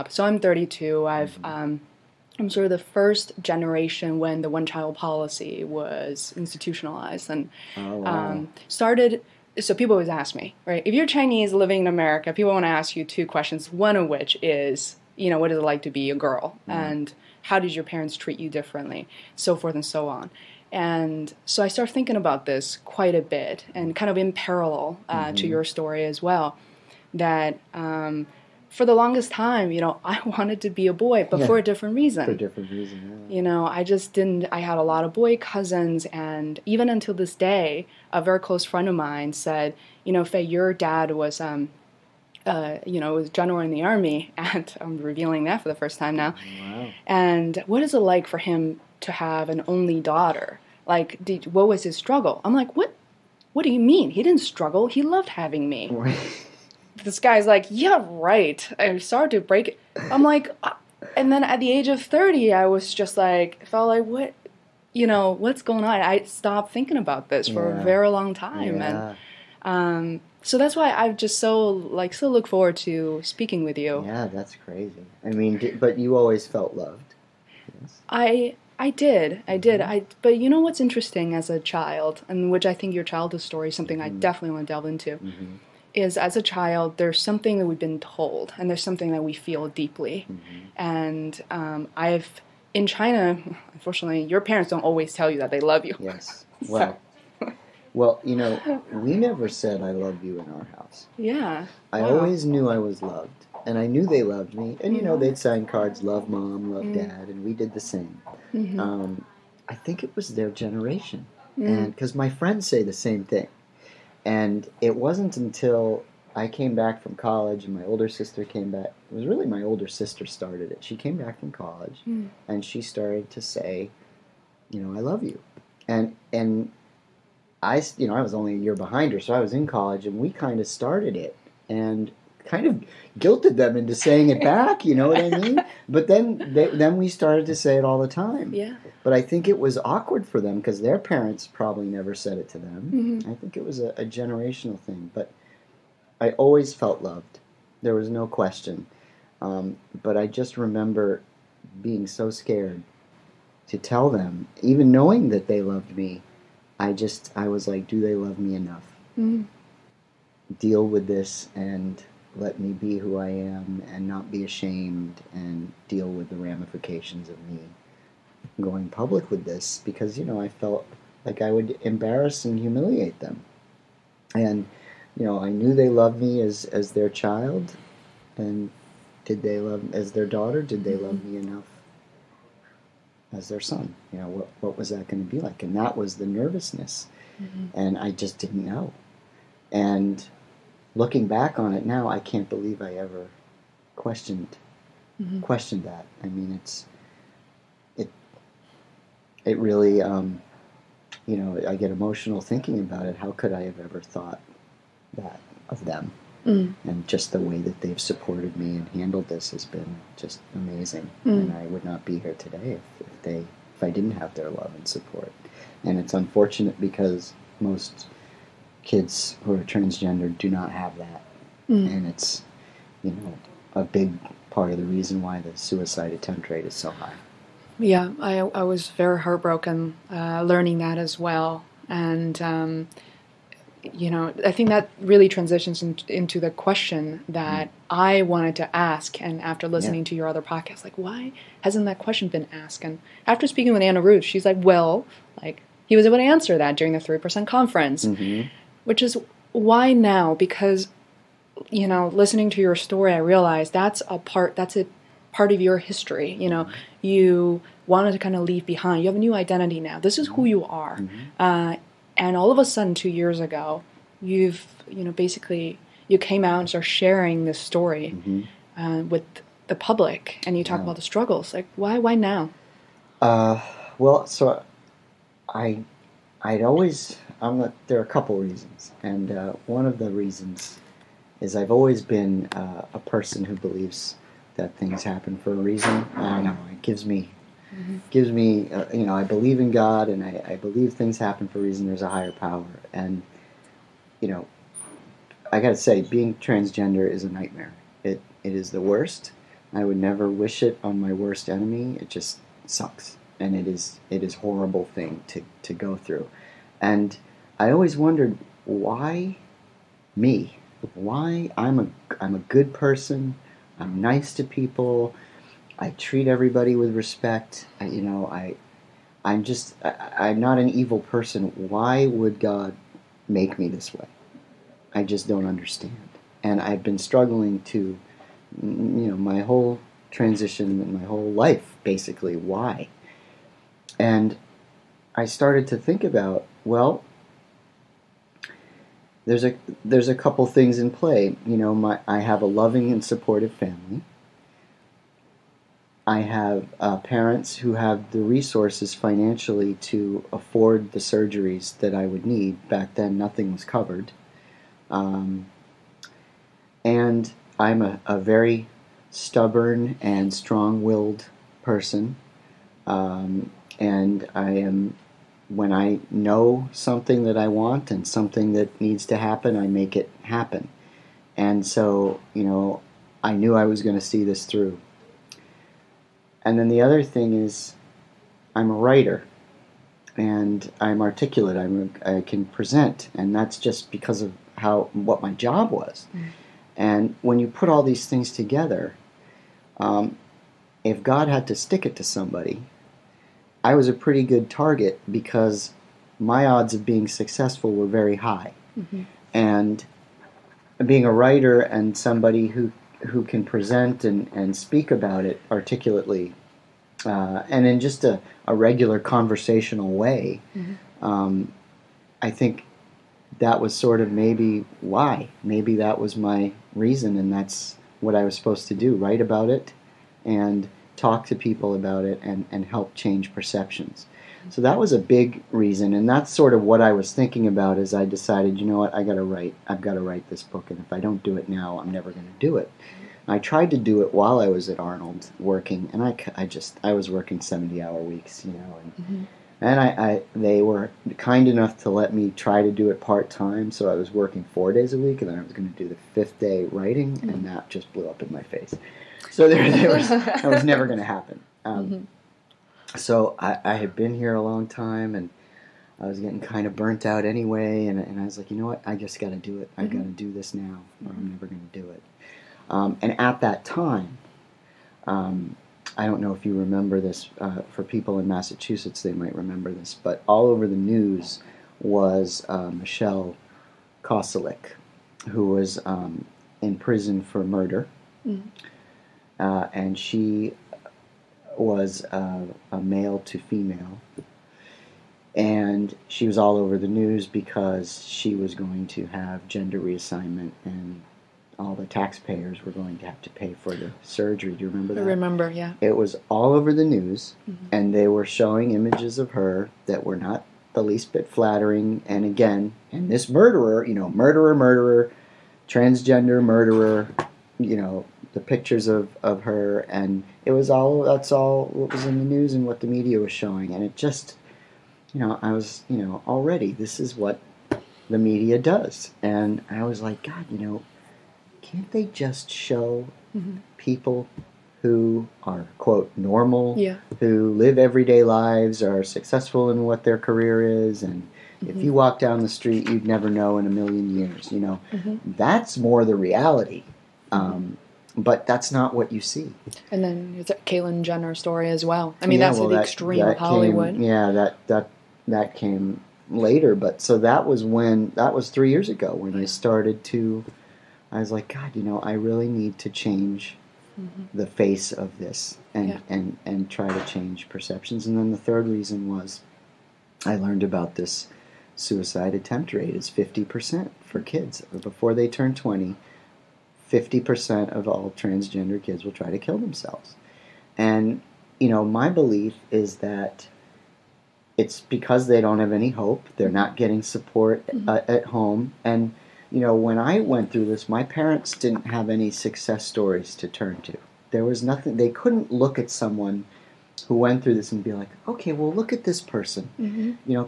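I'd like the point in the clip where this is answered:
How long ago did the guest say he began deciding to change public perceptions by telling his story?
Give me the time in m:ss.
9:08.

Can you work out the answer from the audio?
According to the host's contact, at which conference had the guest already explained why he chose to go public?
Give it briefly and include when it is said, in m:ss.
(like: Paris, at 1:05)
Three Percent Conference, at 4:06.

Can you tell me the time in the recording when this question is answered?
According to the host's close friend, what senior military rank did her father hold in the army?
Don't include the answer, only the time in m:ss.
0:43.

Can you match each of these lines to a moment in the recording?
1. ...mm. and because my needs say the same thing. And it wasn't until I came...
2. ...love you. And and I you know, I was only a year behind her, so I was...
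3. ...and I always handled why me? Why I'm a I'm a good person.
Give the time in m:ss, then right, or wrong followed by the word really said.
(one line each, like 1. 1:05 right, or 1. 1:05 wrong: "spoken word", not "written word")
1. 1:51 wrong: "friends", not "needs"
2. 2:05 right
3. 5:06 wrong: "wondered", not "handled".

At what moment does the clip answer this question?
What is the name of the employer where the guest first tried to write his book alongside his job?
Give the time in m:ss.
7:14.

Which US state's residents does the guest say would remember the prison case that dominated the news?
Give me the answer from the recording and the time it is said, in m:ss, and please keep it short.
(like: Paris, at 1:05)
Massachusetts, at 7:48.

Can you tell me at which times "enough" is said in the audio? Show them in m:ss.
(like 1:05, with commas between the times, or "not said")
2:38, 3:01, 7:21.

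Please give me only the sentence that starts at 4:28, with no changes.
uh, with the public and you talk yeah.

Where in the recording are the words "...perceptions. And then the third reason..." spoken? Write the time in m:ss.
9:17.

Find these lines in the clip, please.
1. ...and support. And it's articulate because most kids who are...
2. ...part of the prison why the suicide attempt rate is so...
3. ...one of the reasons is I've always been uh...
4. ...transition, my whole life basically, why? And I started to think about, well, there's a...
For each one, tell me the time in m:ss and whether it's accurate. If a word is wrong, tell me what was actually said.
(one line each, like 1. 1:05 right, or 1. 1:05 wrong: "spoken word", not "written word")
1. 3:34 wrong: "unfortunate", not "articulate"
2. 3:44 wrong: "reason", not "prison"
3. 4:39 right
4. 5:30 right.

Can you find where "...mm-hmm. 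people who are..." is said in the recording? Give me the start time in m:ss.
8:43.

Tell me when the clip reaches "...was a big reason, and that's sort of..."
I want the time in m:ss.
7:04.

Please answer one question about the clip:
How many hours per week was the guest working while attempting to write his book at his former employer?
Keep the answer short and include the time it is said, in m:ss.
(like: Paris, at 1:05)
70, at 7:17.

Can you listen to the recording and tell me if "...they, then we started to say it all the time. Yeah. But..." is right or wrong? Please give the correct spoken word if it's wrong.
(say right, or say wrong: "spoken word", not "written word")
right.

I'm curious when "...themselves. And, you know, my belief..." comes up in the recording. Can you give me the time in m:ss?
9:29.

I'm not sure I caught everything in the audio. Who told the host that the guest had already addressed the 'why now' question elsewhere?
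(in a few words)
Anna Ruth.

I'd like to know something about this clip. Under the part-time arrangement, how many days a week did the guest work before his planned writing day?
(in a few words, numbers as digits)
4.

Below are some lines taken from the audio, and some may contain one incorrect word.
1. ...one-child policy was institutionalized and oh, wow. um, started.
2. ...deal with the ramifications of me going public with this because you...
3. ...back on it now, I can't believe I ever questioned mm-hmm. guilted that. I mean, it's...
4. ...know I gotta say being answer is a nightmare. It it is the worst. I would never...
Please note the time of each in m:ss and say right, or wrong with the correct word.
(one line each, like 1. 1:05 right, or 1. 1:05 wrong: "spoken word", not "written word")
1. 0:04 right
2. 2:45 right
3. 3:11 wrong: "questioned", not "guilted"
4. 4:54 wrong: "transgender", not "answer".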